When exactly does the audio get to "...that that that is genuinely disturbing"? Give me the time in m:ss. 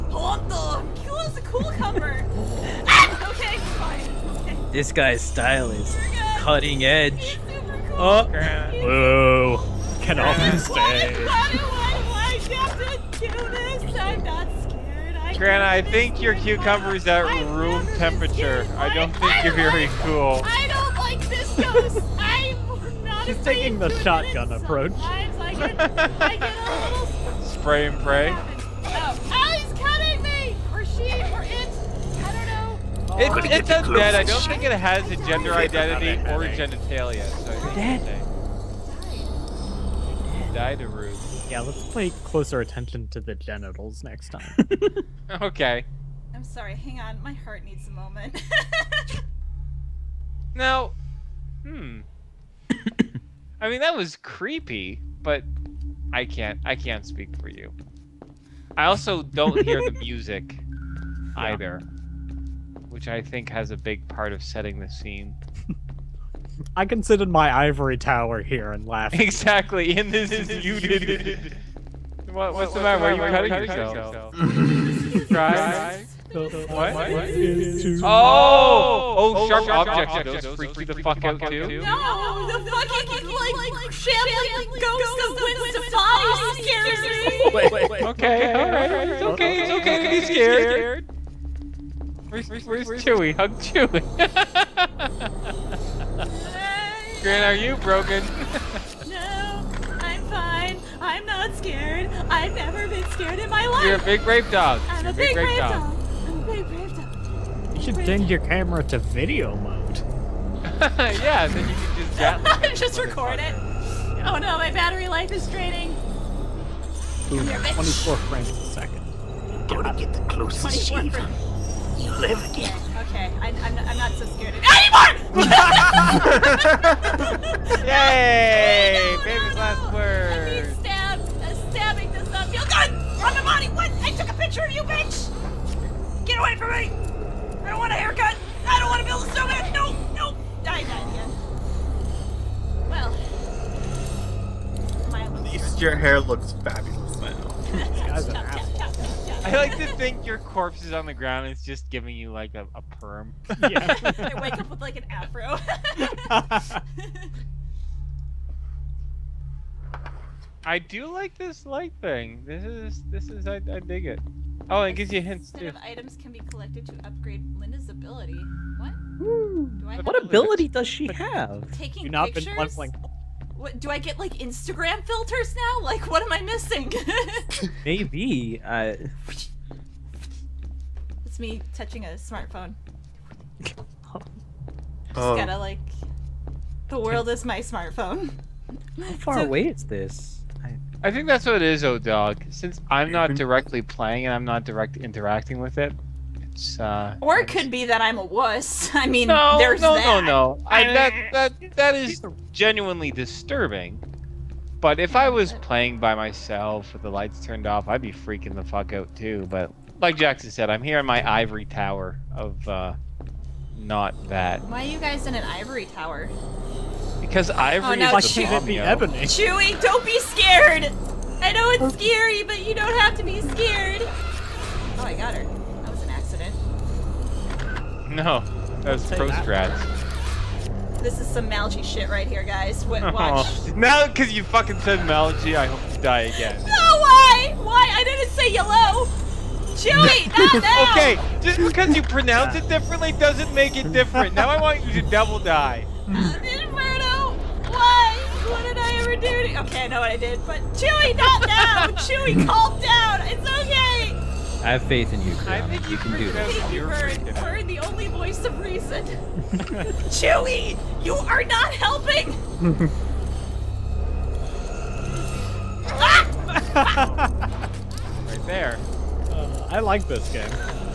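3:20.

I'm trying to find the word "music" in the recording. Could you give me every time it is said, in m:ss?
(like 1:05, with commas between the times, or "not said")
0:59.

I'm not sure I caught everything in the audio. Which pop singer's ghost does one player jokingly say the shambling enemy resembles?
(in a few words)
Gwen Stefani.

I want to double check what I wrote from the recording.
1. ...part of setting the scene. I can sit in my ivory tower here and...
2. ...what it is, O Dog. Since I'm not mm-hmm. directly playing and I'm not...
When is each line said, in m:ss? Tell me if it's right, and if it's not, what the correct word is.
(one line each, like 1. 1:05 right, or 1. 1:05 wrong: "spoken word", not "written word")
1. 1:04 right
2. 3:11 right.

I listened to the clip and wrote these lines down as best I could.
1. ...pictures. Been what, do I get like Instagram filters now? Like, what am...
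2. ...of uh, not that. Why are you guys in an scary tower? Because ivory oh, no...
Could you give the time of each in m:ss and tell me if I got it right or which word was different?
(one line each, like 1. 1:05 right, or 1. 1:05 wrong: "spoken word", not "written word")
1. 2:52 right
2. 3:32 wrong: "ivory", not "scary".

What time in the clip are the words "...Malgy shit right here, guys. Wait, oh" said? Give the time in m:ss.
3:51.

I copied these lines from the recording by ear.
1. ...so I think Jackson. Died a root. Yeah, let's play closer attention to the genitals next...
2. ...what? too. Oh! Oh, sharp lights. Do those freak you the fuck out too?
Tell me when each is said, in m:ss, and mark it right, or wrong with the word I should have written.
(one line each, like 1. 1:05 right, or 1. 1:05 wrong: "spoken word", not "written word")
1. 0:37 wrong: "Dead", not "Jackson"
2. 1:16 wrong: "objects", not "lights".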